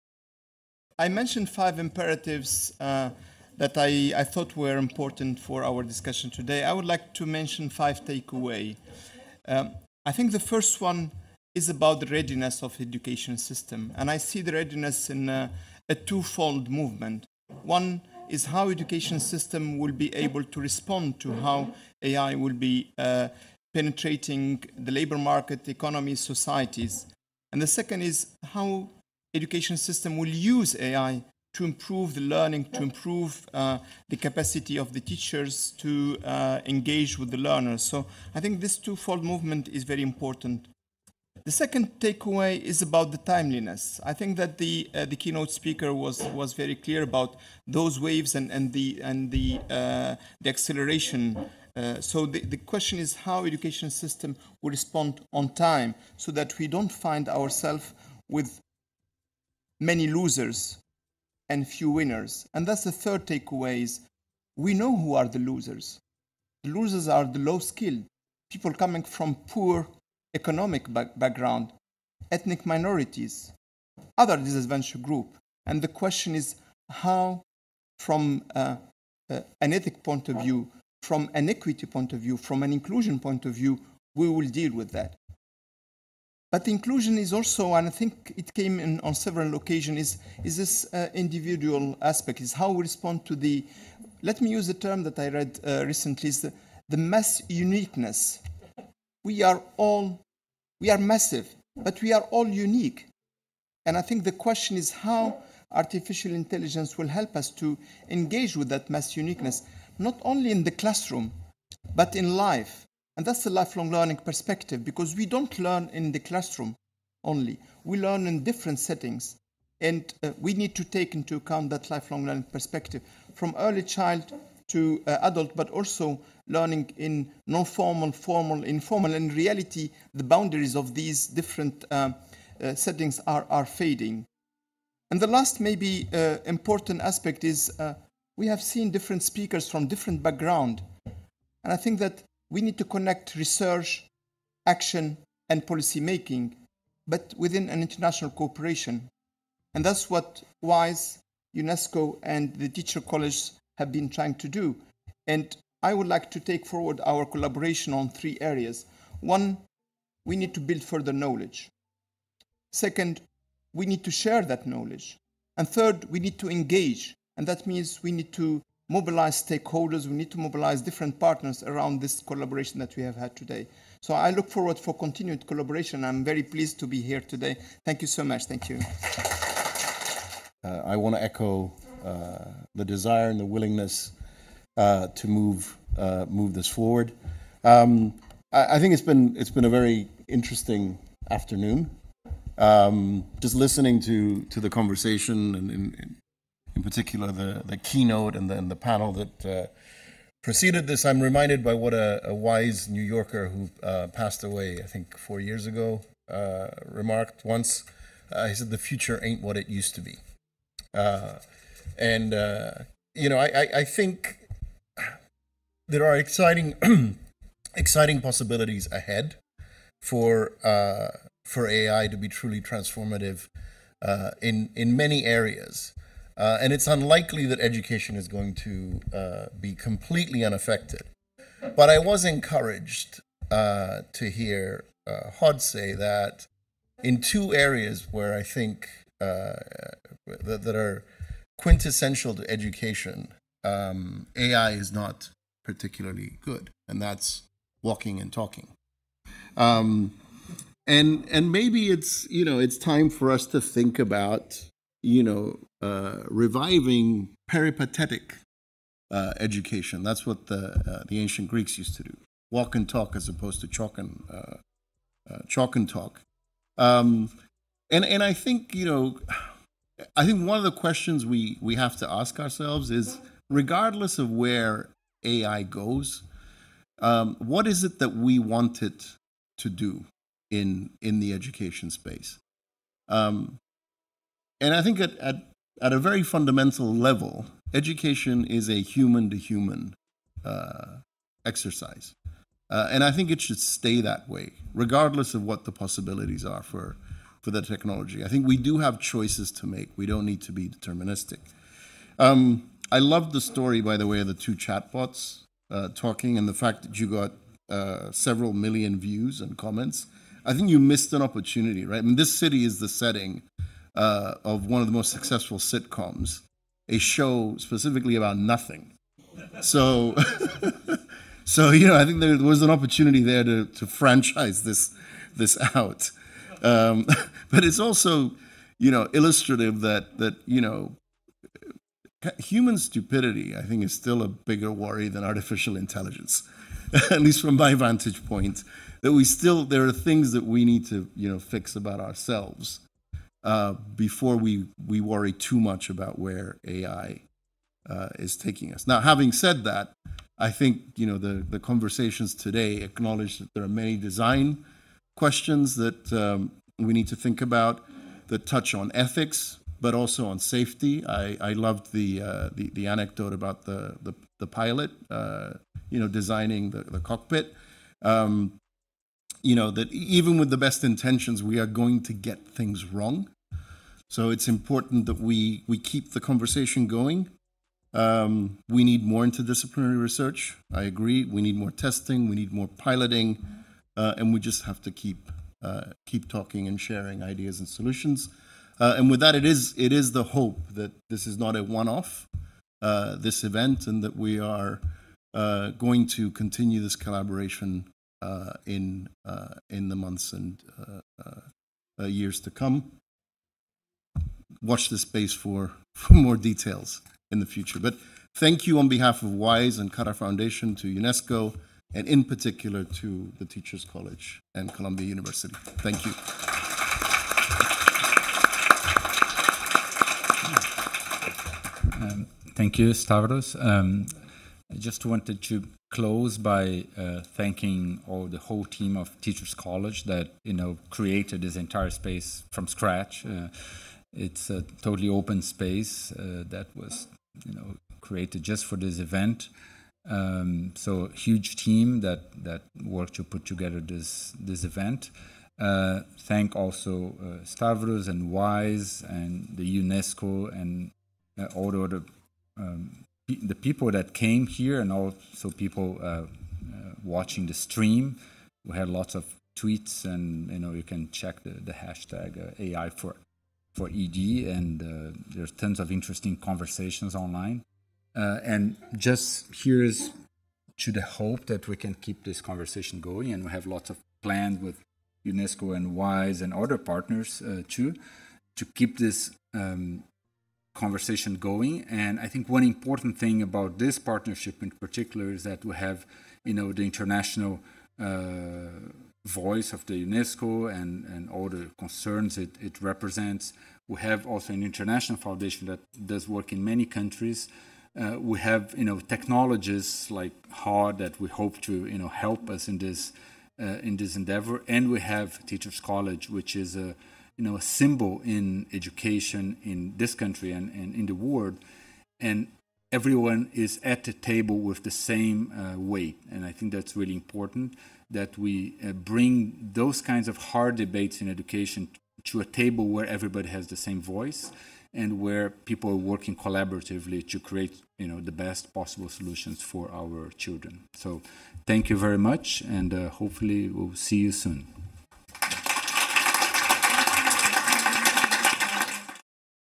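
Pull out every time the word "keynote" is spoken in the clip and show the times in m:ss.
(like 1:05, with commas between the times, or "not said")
0:45, 3:17.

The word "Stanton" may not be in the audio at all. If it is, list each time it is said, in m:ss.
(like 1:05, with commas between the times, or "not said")
not said.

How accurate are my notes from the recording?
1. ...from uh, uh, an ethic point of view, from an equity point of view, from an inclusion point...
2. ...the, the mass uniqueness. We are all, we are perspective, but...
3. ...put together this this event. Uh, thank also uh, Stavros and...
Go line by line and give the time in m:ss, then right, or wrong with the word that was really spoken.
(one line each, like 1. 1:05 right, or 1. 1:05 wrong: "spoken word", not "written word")
1. 1:17 right
2. 1:36 wrong: "massive", not "perspective"
3. 7:23 right.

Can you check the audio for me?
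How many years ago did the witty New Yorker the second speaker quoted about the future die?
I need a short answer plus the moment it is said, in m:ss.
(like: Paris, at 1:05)
4, at 3:25.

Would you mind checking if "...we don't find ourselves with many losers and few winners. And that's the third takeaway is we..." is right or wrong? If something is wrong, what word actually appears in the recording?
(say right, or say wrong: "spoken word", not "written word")
right.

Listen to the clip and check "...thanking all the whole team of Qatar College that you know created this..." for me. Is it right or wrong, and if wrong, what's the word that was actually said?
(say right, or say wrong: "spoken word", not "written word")
wrong: "Teachers", not "Qatar".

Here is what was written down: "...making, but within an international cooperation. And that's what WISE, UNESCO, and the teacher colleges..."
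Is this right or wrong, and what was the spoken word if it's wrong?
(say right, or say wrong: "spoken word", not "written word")
right.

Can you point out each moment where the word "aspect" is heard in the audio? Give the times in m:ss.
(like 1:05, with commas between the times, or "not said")
1:32, 2:17.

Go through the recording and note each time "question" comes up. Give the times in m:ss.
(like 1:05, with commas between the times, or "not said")
0:52, 1:15, 1:44, 4:30, 5:55.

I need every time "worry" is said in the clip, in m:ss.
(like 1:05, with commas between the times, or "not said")
5:34, 5:45.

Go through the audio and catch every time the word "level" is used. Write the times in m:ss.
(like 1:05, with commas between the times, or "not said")
4:46.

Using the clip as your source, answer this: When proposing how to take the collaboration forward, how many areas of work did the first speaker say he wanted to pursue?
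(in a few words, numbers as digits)
3.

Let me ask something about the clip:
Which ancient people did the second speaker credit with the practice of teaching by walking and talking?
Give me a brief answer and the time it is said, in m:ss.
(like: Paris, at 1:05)
the ancient Greeks, at 4:21.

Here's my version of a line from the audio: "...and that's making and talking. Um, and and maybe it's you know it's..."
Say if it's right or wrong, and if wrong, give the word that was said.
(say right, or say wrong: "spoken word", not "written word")
wrong: "walking", not "making".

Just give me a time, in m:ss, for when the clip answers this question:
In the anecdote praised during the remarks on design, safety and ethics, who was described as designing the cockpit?
6:04.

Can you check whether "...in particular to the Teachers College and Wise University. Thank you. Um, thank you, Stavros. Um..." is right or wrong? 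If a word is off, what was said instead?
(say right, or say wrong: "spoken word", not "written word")
wrong: "Columbia", not "Wise".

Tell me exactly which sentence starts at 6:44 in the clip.
Watch this space for, for more details in the future.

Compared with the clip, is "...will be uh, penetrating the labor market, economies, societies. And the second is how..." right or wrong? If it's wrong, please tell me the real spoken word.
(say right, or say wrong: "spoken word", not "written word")
right.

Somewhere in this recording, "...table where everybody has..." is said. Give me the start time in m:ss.
8:42.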